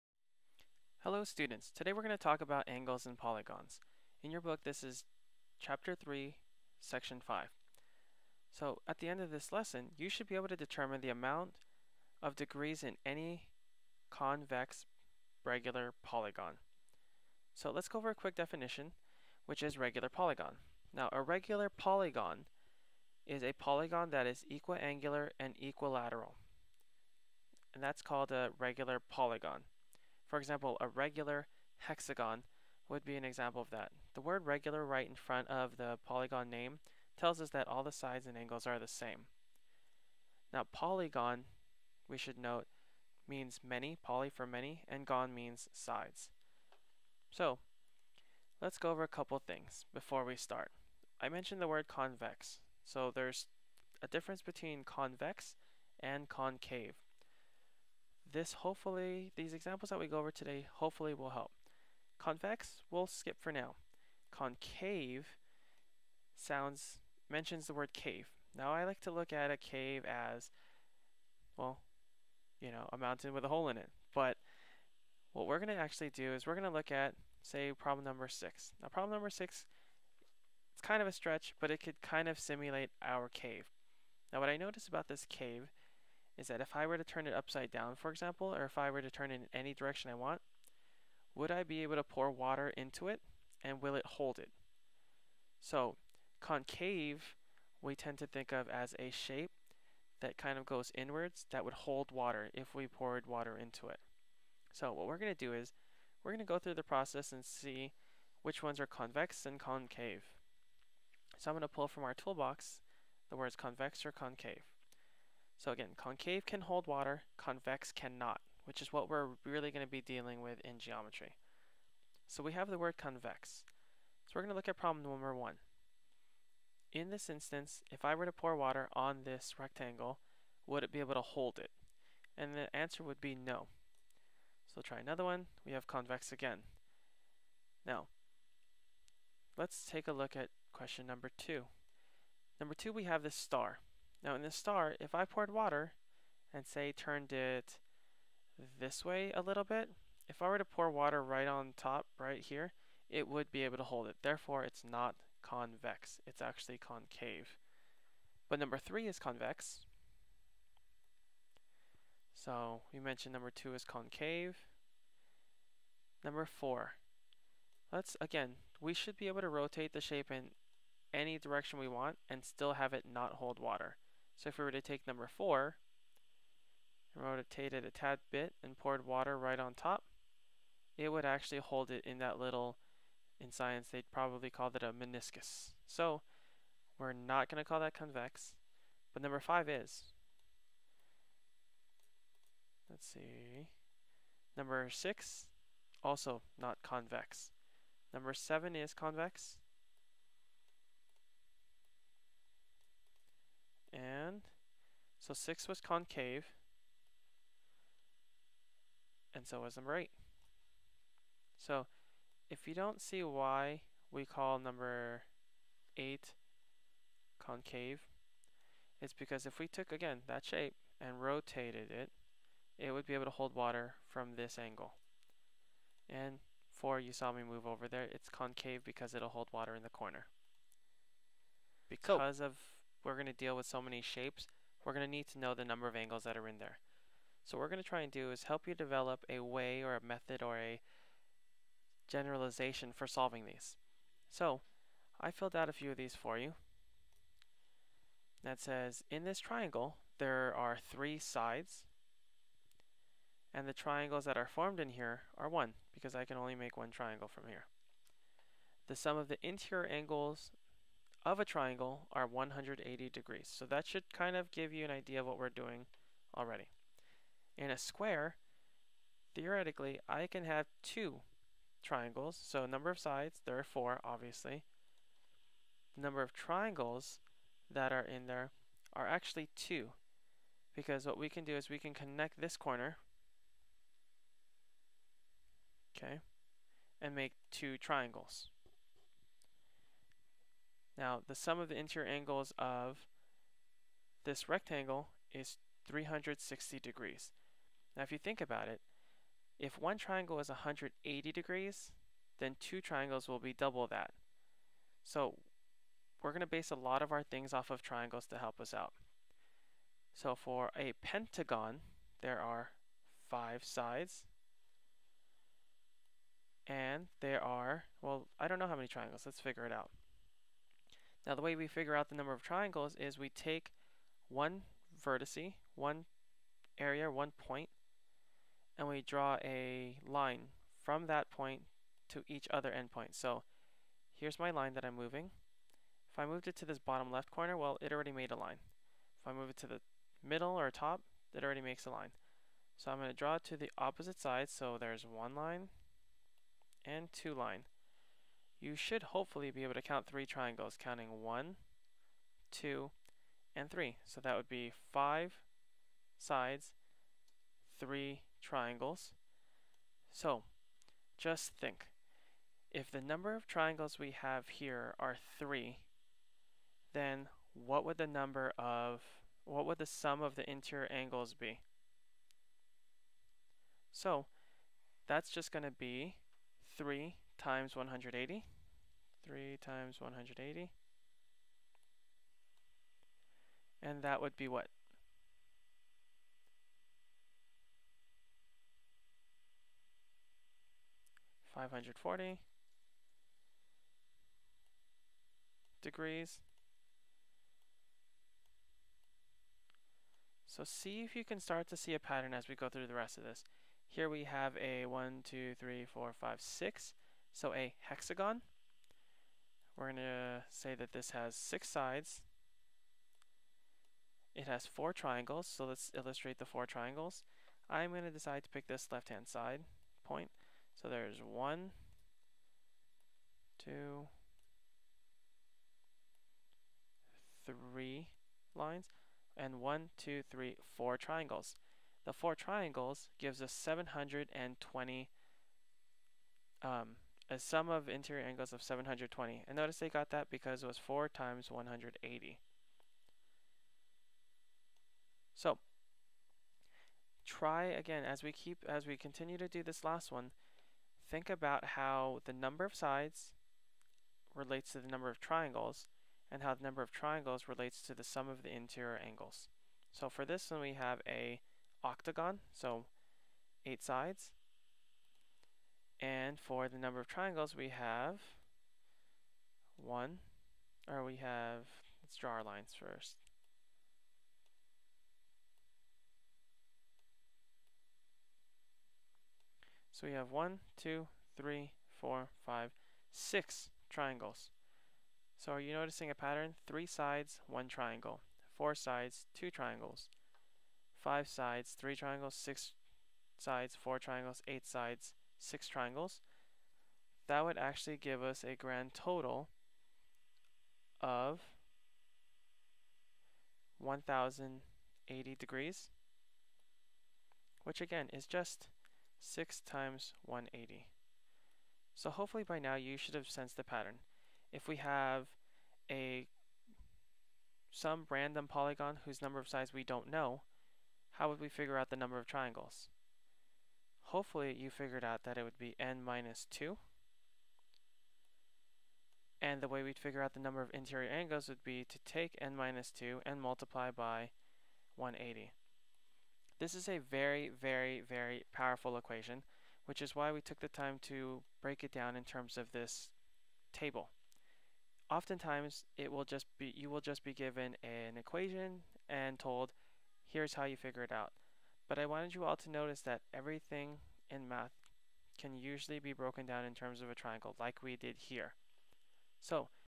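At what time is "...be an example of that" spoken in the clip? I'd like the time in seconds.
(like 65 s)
33 s.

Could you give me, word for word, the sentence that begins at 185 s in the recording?
So we're not going to call that convex, but number 5 is.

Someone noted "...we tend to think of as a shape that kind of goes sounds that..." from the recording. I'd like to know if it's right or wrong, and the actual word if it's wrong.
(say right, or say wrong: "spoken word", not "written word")
wrong: "inwards", not "sounds".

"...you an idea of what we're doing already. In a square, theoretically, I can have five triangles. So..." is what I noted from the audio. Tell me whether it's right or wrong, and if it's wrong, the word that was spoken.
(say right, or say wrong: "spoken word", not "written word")
wrong: "two", not "five".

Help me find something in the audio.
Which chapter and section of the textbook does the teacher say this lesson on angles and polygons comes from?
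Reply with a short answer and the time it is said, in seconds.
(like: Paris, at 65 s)
Chapter 3, section 5, at 5 s.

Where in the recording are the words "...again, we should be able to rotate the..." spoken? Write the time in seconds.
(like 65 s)
168 s.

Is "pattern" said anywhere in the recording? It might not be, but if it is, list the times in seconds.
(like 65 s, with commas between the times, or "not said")
401 s, 486 s, 513 s.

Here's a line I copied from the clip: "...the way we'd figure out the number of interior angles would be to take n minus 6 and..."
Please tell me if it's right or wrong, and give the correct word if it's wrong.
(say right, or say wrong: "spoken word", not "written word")
wrong: "2", not "6".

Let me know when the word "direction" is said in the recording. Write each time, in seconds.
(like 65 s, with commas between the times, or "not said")
89 s, 171 s.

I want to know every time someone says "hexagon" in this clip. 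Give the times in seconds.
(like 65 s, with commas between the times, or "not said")
31 s, 407 s.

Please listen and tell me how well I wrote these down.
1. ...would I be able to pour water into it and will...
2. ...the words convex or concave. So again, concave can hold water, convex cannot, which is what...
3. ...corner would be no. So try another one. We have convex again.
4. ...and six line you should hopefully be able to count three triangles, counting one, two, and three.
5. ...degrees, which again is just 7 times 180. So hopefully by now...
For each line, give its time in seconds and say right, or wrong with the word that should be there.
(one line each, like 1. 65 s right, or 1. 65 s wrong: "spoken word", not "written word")
1. 91 s right
2. 113 s right
3. 132 s wrong: "answer", not "corner"
4. 346 s wrong: "two", not "six"
5. 505 s wrong: "6", not "7".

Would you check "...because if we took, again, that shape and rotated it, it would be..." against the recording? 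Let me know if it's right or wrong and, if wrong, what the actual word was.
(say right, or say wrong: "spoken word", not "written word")
right.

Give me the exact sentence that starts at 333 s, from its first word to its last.
So here's my line that I'm moving.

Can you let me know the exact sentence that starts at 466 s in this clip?
And for the number of triangles, we have one, or we have, let's draw our lines first.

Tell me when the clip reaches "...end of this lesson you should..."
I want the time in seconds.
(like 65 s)
9 s.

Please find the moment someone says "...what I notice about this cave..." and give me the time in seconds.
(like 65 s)
84 s.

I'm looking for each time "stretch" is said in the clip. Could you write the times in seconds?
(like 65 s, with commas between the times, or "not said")
81 s.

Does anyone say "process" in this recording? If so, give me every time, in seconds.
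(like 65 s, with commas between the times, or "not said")
106 s.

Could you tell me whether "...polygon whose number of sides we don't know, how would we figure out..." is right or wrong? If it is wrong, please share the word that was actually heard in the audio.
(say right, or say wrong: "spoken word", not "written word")
right.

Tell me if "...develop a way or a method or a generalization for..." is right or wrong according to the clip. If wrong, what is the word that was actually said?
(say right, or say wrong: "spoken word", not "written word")
right.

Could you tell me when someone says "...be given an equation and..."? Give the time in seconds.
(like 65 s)
547 s.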